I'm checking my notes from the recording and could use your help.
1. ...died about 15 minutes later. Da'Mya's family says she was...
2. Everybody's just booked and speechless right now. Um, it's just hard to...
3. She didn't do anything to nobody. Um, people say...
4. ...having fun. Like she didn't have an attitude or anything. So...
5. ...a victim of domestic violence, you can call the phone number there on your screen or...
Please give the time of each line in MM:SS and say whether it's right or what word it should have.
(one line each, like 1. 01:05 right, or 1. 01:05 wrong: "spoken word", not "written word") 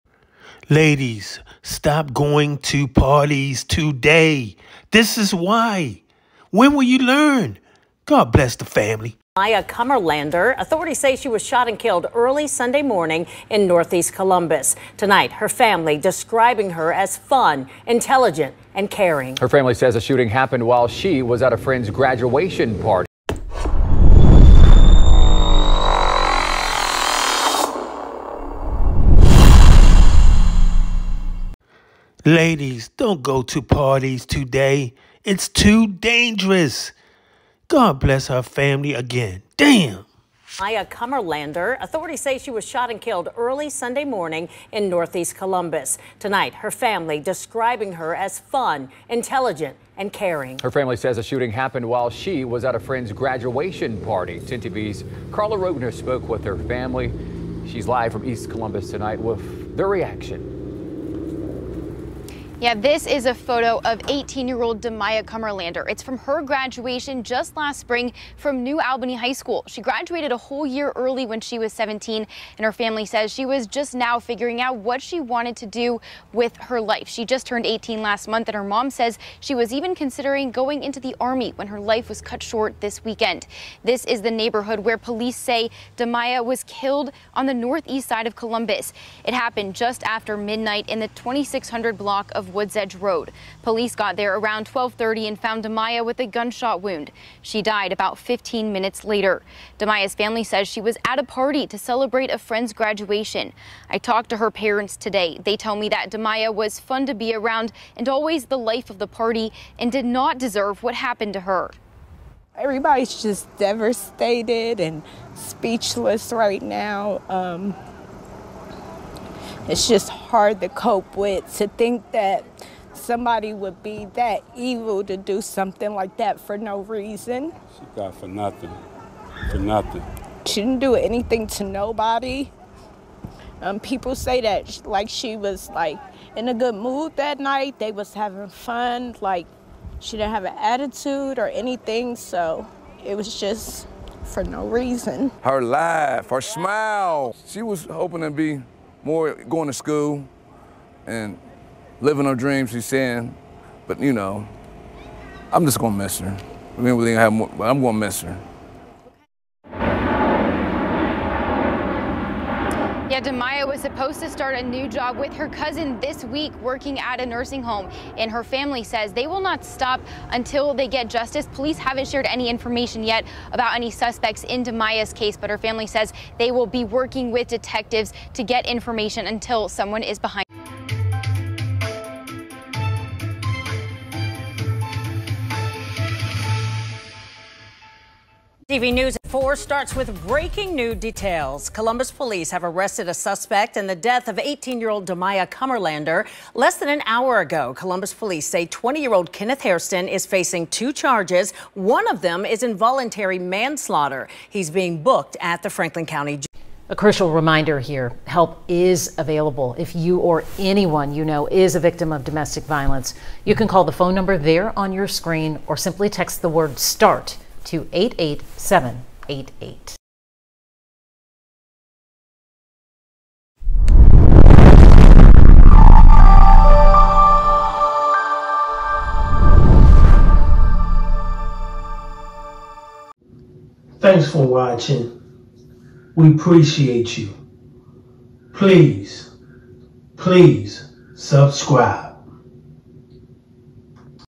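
1. 01:37 right
2. 01:52 wrong: "devastated", not "booked"
3. 02:10 right
4. 02:18 right
5. 03:31 right.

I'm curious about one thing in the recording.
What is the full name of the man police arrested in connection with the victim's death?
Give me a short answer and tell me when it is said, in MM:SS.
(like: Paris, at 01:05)
Kenneth Hairston, at 03:19.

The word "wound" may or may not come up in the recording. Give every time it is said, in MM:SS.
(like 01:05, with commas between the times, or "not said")
01:36.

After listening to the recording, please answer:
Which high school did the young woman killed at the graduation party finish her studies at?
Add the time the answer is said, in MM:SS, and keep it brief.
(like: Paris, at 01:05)
New Albany High School, at 01:08.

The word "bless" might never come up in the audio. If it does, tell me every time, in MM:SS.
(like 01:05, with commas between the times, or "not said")
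00:08, 00:37.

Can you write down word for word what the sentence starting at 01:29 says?
It happened just after midnight in the 2600 block of Woods Edge Road.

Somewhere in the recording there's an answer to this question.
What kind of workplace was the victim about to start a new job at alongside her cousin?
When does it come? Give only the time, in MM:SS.
02:47.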